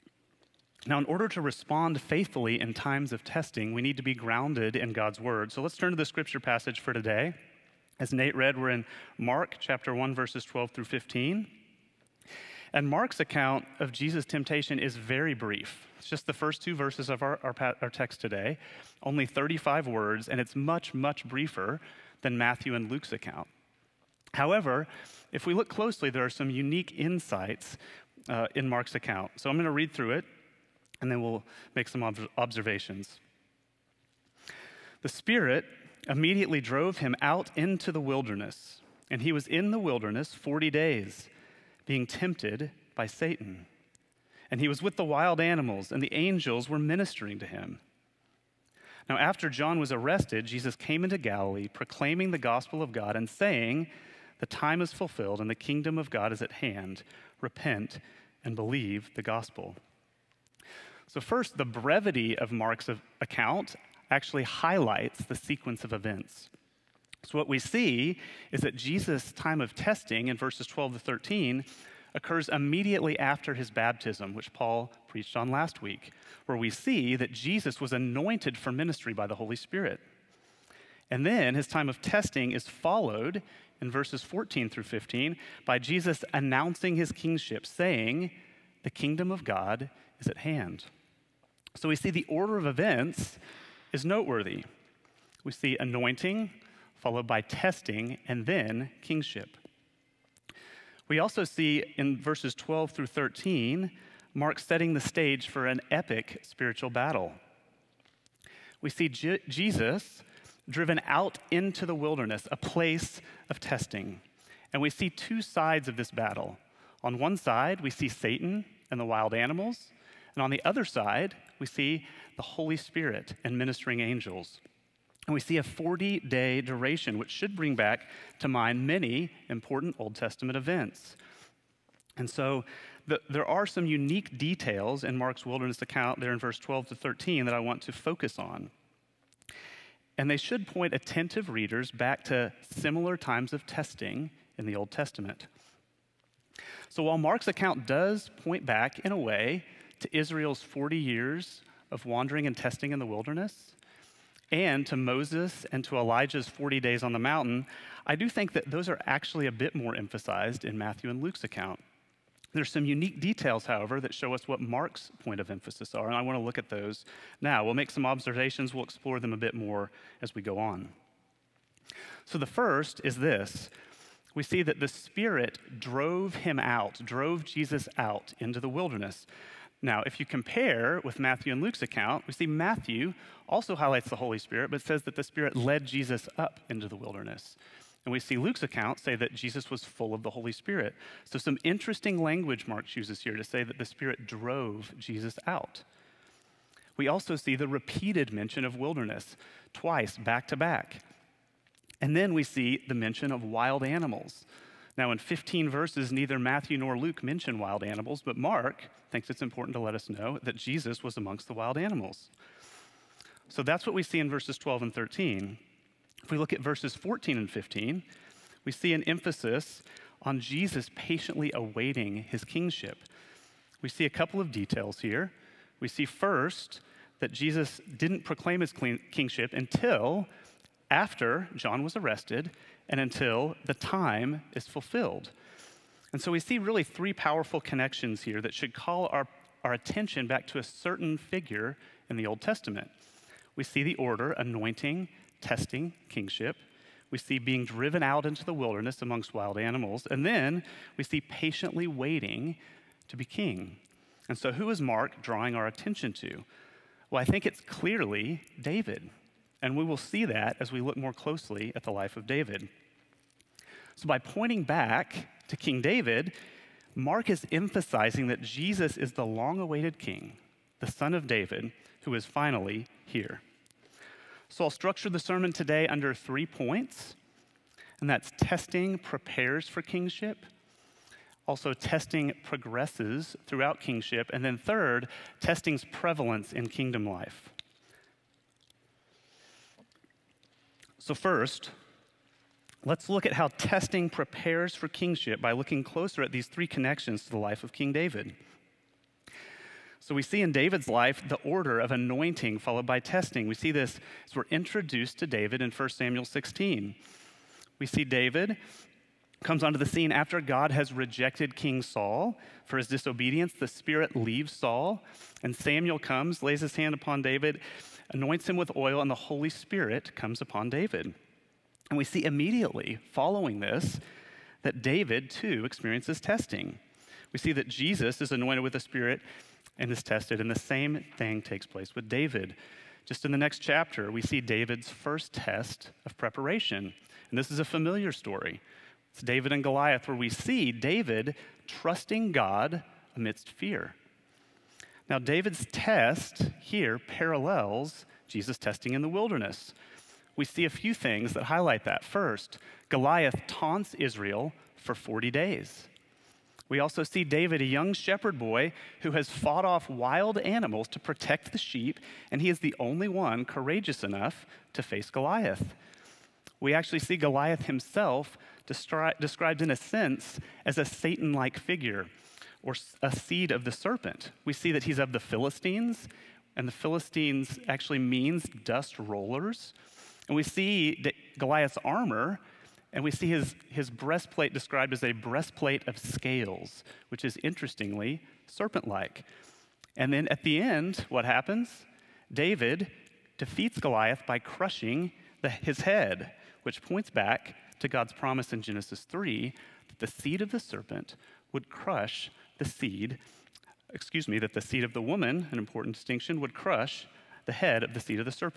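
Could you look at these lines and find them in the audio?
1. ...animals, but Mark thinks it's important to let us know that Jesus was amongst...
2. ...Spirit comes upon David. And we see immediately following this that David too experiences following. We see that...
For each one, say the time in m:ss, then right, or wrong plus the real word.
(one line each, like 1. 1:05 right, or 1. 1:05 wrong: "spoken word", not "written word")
1. 3:27 right
2. 5:19 wrong: "testing", not "following".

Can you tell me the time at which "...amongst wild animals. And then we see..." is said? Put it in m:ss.
4:09.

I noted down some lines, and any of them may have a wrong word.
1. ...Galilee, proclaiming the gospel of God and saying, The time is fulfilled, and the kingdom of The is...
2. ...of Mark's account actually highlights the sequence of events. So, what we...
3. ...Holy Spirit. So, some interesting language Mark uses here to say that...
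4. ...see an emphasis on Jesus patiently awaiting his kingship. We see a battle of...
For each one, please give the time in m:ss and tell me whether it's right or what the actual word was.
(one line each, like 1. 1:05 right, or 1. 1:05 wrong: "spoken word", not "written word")
1. 0:51 wrong: "God", not "The"
2. 1:02 right
3. 3:10 right
4. 3:38 wrong: "couple", not "battle".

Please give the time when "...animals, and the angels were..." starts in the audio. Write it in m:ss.
0:45.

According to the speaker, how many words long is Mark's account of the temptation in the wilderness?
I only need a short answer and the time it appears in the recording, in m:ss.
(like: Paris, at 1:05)
35, at 0:19.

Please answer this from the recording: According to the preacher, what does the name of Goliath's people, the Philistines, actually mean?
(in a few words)
dust rollers.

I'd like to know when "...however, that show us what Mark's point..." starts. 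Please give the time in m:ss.
2:43.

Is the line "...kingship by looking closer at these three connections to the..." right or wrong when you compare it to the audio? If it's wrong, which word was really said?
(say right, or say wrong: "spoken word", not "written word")
right.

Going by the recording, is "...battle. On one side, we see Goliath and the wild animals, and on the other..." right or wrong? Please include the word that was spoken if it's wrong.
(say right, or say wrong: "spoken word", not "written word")
wrong: "Satan", not "Goliath".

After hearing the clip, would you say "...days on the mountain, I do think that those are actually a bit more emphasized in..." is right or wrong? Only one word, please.
right.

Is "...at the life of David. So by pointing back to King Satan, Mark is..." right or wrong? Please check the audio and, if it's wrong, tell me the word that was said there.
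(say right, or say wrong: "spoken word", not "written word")
wrong: "David", not "Satan".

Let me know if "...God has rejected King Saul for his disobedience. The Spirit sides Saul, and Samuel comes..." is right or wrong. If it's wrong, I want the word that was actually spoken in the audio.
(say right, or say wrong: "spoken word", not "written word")
wrong: "leaves", not "sides".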